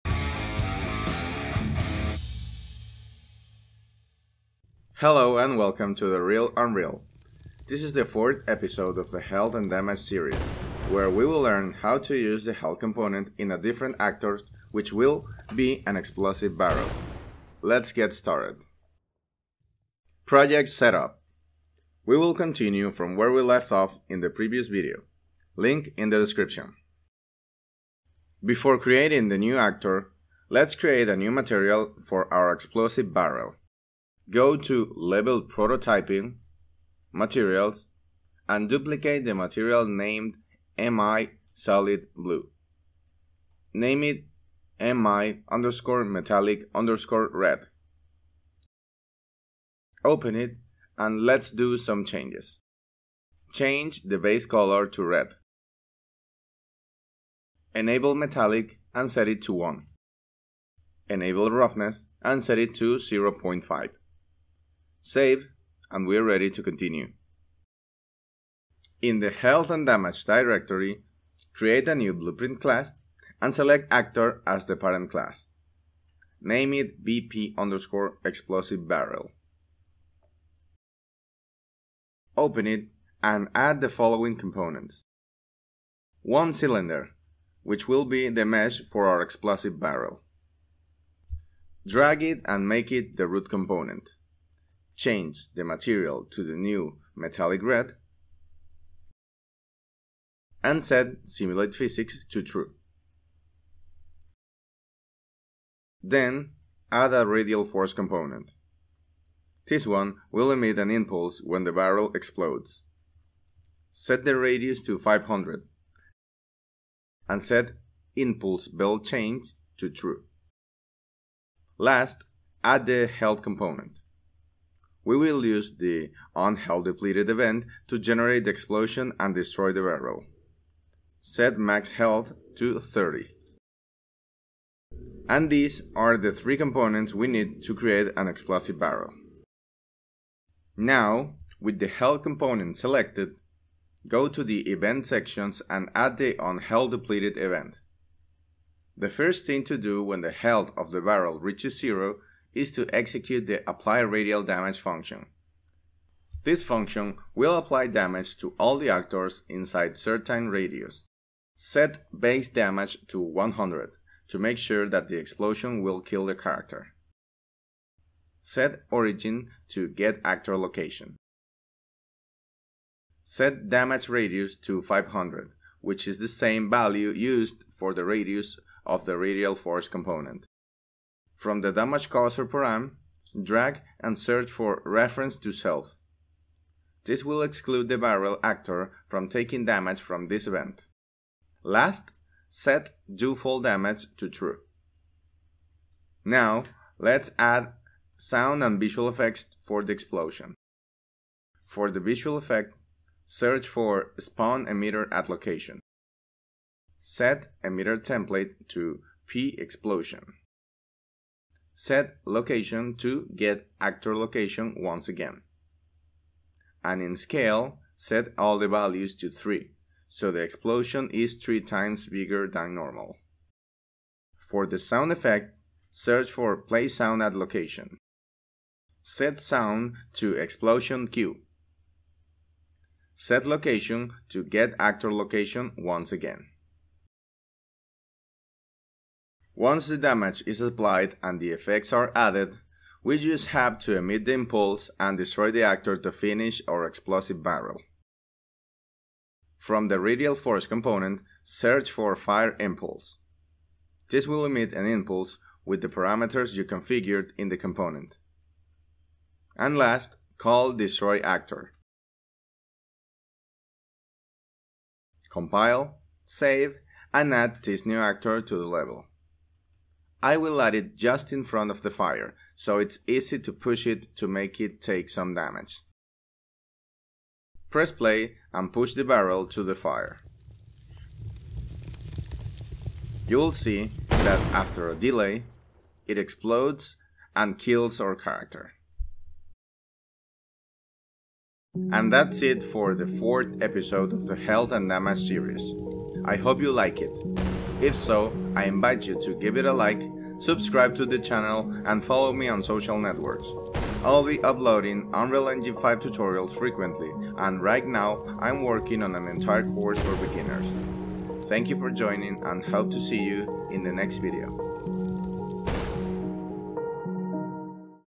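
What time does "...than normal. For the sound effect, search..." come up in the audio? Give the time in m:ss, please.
3:42.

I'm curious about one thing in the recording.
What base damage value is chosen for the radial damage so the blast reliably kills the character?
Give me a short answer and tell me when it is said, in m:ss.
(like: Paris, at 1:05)
100, at 2:41.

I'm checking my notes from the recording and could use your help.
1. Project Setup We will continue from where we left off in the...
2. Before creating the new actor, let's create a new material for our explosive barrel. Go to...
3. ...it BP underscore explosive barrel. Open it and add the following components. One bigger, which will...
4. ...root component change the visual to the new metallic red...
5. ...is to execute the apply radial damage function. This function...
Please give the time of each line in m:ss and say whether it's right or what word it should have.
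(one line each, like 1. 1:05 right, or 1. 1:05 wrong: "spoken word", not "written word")
1. 0:20 right
2. 0:28 right
3. 1:16 wrong: "cylinder", not "bigger"
4. 1:33 wrong: "material", not "visual"
5. 2:32 right.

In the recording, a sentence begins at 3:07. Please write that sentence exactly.
This will exclude the barrel actor from taking damage from this event.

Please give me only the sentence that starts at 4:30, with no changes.
I will light it just in front of the fire, so it's easy to push it to make it take some damage.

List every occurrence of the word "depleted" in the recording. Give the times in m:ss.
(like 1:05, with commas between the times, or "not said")
2:06, 2:26.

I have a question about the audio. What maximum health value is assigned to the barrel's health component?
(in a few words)
30.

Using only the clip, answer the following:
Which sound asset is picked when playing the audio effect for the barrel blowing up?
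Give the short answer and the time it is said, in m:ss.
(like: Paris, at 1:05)
Explosion Cue, at 3:50.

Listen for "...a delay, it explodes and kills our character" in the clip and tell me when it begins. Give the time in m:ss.
4:44.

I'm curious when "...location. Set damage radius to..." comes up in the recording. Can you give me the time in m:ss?
2:50.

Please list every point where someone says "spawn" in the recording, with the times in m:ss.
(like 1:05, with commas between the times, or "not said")
3:24.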